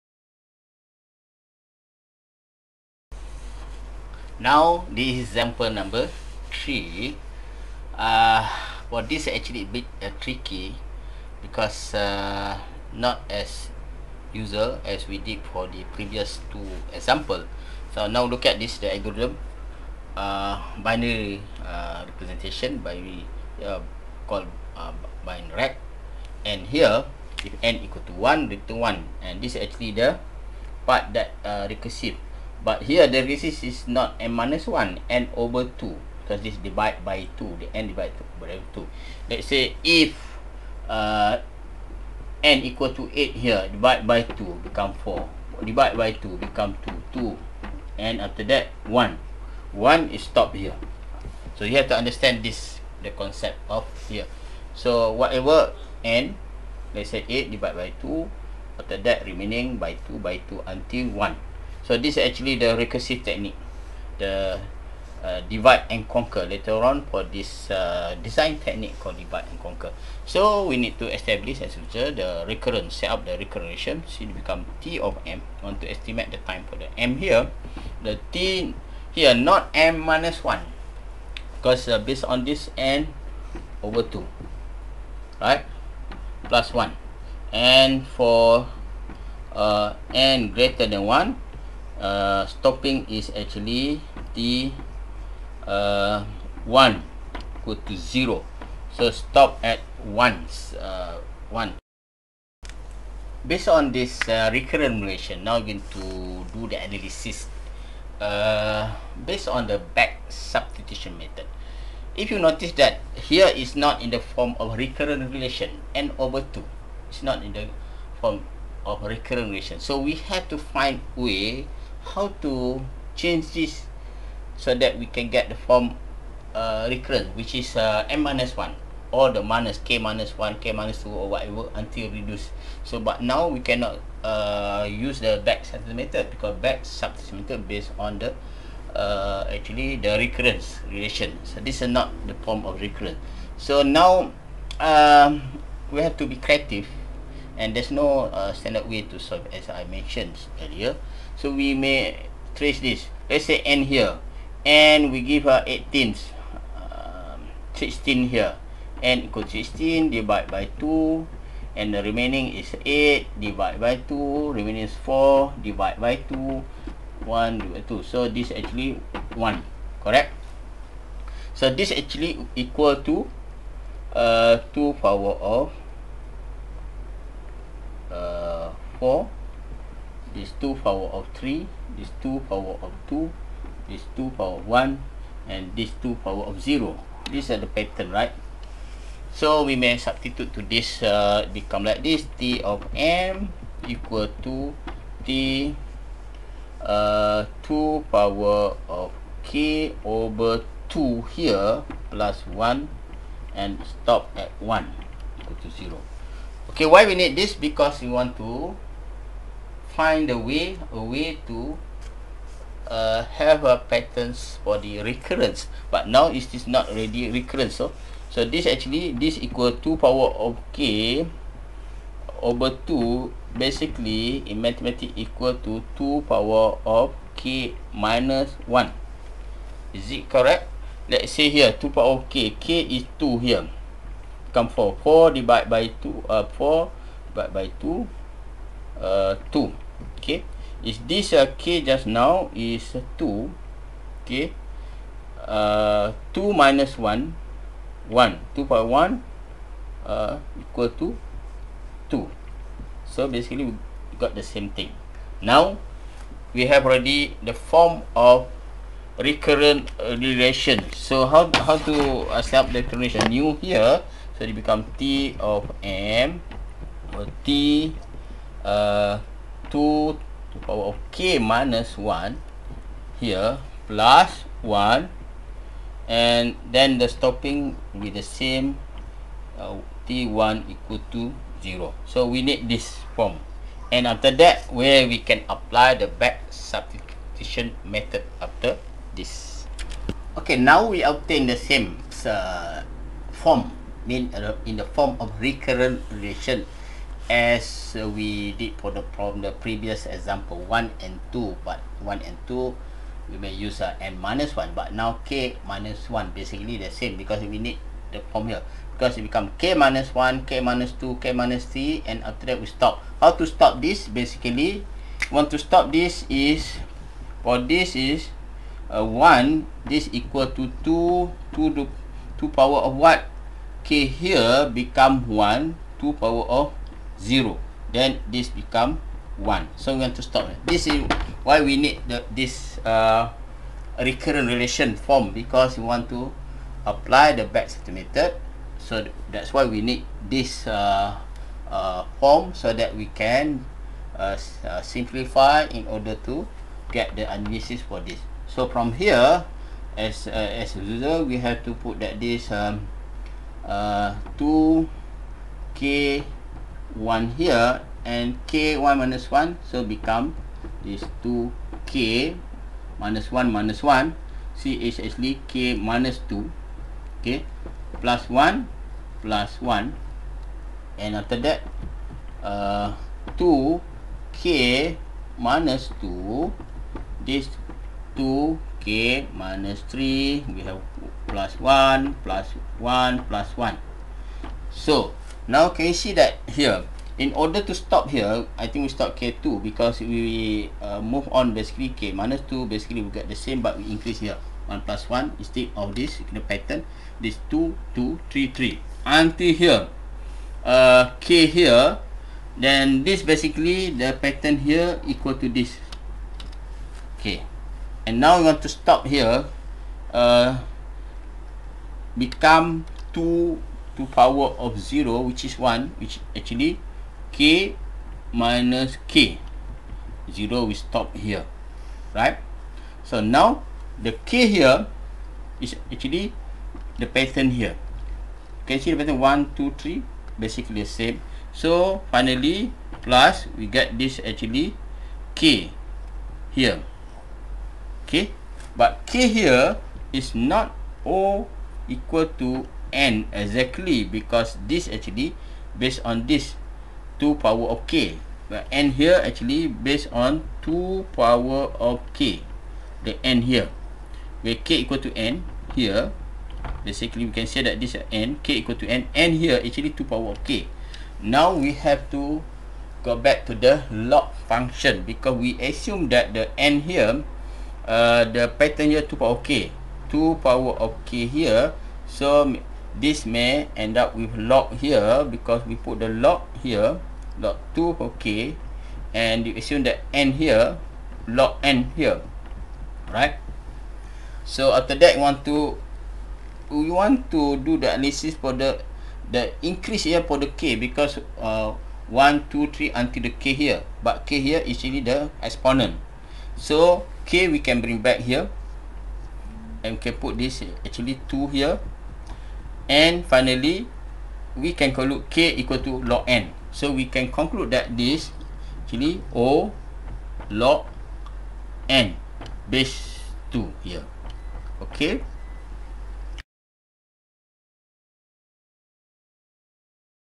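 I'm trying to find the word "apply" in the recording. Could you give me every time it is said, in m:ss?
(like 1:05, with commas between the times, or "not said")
4:45, 5:36.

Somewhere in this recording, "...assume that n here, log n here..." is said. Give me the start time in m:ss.
7:59.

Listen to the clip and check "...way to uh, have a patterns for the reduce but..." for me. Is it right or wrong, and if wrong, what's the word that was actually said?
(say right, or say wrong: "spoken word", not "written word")
wrong: "recurrence", not "reduce".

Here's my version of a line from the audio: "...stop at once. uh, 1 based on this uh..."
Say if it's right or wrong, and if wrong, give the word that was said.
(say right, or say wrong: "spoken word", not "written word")
right.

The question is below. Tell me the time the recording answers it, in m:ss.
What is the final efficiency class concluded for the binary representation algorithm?
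8:29.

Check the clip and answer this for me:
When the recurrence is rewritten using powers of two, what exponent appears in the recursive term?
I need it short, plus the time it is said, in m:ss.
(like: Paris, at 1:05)
k minus 1, at 4:29.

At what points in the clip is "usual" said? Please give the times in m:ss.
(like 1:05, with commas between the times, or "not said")
0:14, 1:11.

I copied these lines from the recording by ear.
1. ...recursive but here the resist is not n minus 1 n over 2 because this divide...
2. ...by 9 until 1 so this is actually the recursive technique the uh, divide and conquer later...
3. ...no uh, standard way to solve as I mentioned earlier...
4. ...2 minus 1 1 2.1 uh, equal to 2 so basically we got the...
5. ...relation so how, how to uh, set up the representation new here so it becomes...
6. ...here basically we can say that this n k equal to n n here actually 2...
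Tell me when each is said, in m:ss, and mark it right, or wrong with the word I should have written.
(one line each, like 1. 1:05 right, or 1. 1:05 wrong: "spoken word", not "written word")
1. 0:31 right
2. 1:00 wrong: "2", not "9"
3. 2:27 right
4. 4:06 right
5. 4:20 wrong: "relation", not "representation"
6. 7:35 right.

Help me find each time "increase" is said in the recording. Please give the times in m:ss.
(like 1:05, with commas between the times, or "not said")
6:33, 8:09.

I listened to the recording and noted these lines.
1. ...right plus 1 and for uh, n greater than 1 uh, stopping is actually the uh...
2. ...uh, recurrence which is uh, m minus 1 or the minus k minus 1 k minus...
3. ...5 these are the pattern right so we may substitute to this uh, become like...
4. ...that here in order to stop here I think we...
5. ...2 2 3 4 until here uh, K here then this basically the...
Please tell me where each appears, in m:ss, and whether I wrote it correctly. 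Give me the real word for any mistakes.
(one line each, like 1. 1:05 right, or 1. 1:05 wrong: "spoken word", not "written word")
1. 1:25 right
2. 2:06 right
3. 3:06 wrong: "0", not "5"
4. 6:26 right
5. 6:37 wrong: "3", not "4".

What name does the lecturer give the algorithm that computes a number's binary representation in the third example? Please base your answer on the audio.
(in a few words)
bind.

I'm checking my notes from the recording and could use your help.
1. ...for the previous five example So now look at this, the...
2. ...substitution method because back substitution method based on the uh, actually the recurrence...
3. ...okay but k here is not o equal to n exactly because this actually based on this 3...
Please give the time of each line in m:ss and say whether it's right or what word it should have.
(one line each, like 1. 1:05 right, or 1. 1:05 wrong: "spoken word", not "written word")
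1. 0:15 wrong: "two", not "five"
2. 2:15 right
3. 7:18 wrong: "2", not "3".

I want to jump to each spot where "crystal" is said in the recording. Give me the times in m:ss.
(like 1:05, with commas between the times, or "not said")
not said.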